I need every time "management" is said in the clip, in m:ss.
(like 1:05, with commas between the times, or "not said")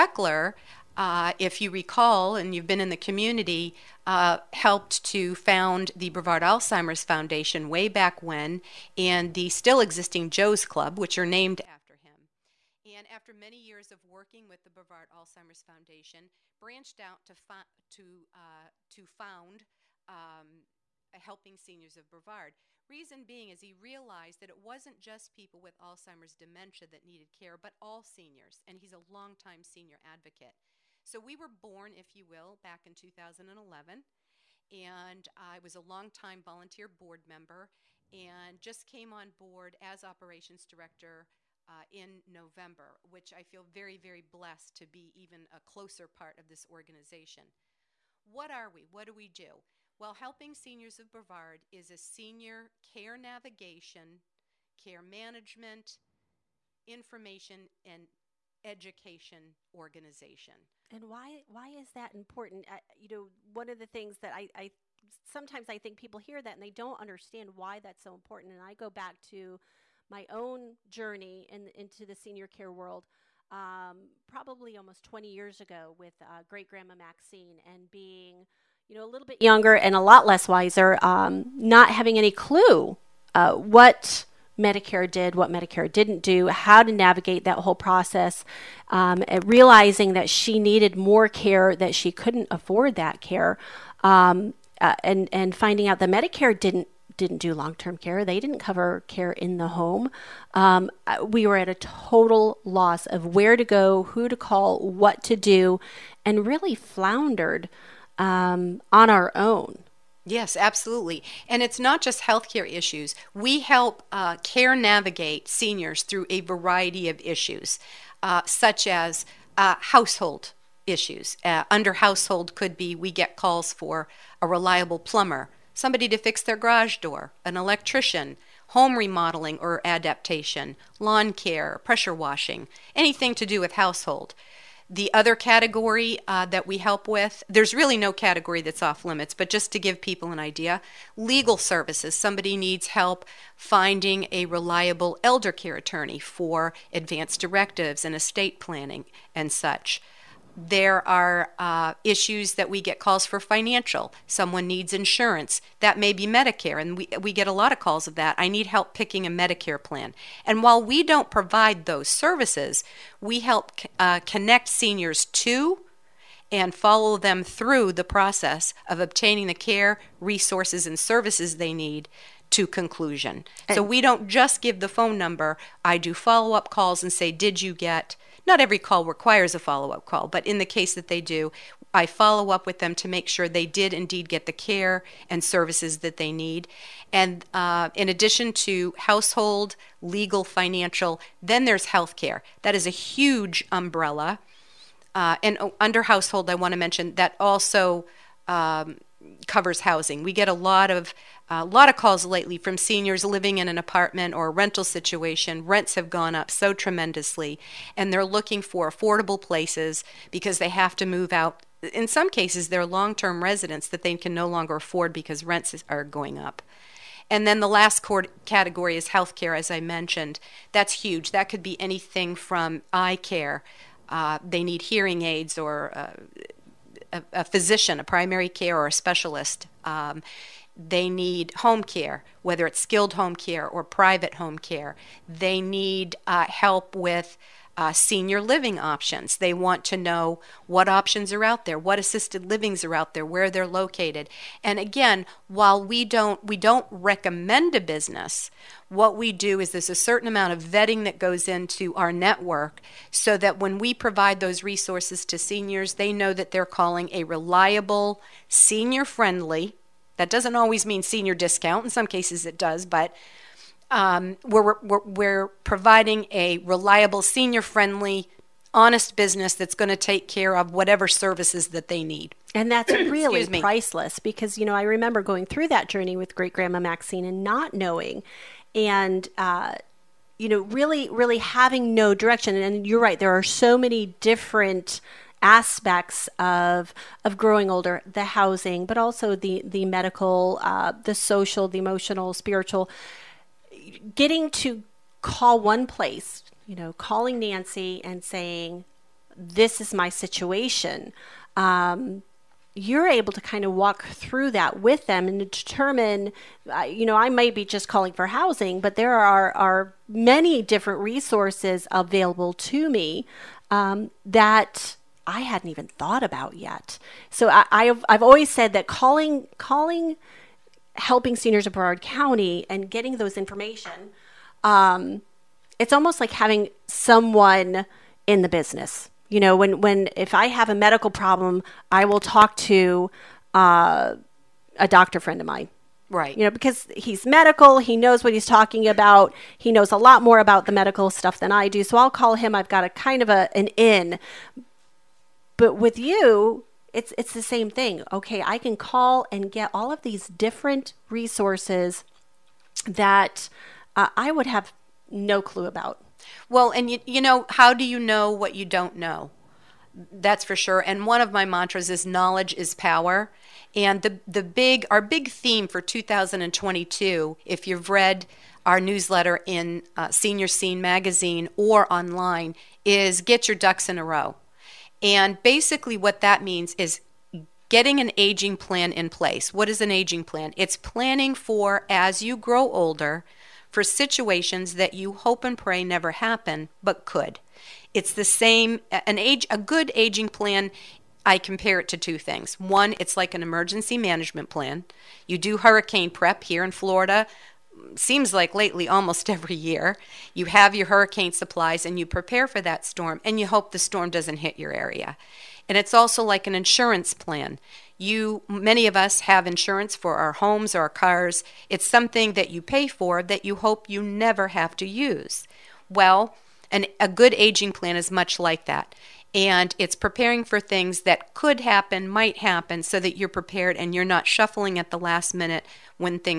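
0:55, 6:33.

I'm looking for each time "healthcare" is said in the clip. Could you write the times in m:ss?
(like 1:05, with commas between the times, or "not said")
1:52, 3:11, 3:39.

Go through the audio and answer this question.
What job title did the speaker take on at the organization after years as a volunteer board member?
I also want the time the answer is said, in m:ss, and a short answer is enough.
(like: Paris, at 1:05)
operations director, at 0:40.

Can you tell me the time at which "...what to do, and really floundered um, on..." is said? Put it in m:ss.
1:44.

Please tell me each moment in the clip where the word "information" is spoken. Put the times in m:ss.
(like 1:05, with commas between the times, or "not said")
0:56, 5:23.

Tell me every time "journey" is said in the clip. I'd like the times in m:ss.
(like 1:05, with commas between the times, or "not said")
1:10, 4:35.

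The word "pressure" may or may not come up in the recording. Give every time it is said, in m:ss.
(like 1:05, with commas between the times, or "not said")
2:11.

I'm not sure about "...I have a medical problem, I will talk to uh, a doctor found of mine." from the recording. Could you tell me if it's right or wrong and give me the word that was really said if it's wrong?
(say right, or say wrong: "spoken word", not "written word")
wrong: "friend", not "found".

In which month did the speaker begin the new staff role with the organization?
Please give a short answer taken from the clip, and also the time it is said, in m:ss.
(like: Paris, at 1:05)
November, at 0:42.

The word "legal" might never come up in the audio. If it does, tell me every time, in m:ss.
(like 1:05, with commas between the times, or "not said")
2:21, 3:10.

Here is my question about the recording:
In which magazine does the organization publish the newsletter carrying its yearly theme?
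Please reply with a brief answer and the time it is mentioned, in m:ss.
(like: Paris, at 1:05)
Senior Scene, at 6:10.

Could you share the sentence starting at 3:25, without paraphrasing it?
Rents have gone up so tremendously, and they're looking for affordable places because they have to move out.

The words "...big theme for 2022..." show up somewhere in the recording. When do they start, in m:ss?
6:05.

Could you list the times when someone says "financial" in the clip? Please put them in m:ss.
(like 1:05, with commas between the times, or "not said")
2:33, 3:10.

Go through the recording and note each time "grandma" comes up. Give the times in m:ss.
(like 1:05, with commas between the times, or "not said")
1:16, 4:36.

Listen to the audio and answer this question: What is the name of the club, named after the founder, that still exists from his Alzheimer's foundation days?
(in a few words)
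Joe's Club.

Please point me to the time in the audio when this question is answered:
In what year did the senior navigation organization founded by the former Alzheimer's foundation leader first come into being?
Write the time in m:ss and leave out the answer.
0:32.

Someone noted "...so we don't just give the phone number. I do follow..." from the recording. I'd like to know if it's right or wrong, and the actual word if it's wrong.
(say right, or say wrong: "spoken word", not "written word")
right.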